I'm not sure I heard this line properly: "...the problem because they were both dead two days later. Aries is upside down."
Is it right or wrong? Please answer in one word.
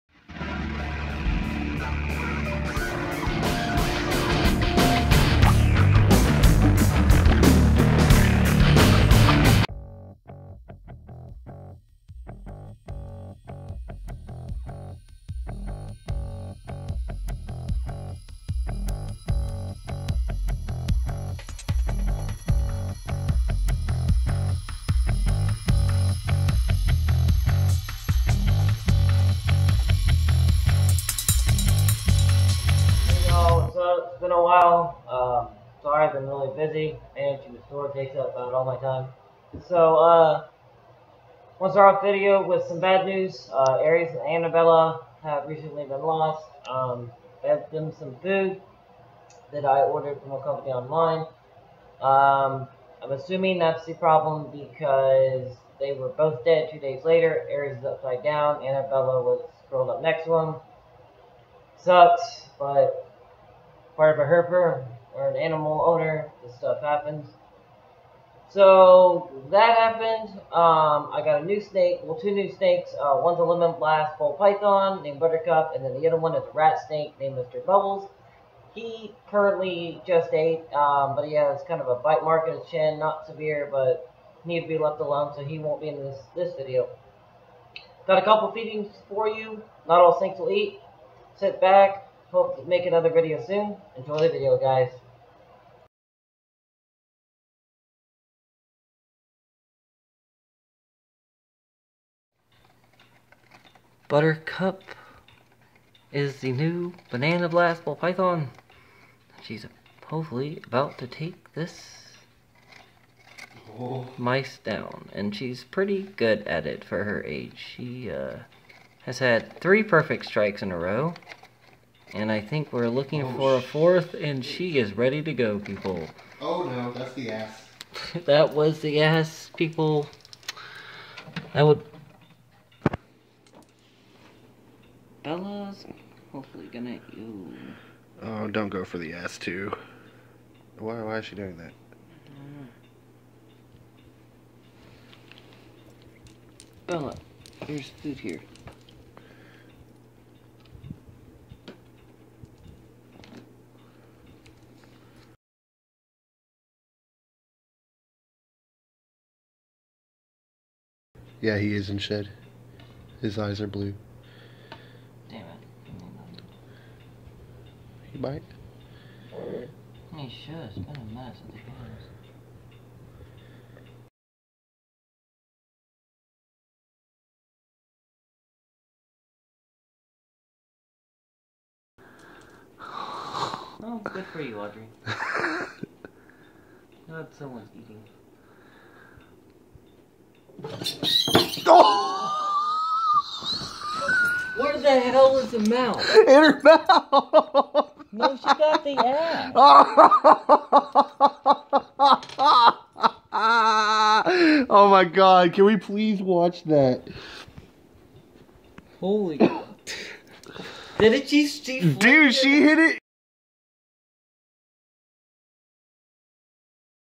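right.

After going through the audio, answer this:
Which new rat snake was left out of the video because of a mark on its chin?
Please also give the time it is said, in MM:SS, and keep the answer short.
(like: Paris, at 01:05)
Mr. Bubbles, at 01:17.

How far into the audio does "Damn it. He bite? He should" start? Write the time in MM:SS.
02:45.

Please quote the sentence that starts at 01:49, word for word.
She's hopefully about to take this mice down.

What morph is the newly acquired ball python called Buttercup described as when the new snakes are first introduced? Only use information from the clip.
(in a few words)
lemon blast.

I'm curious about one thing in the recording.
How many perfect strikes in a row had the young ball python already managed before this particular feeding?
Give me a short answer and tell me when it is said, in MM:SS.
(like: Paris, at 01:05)
3, at 01:59.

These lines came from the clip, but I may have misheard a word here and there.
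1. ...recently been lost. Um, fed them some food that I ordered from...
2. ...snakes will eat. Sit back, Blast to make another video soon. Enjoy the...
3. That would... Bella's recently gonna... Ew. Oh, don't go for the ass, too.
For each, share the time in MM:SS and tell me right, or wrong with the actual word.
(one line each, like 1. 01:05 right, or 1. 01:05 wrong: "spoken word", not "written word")
1. 00:45 right
2. 01:30 wrong: "Hope", not "Blast"
3. 02:11 wrong: "hopefully", not "recently".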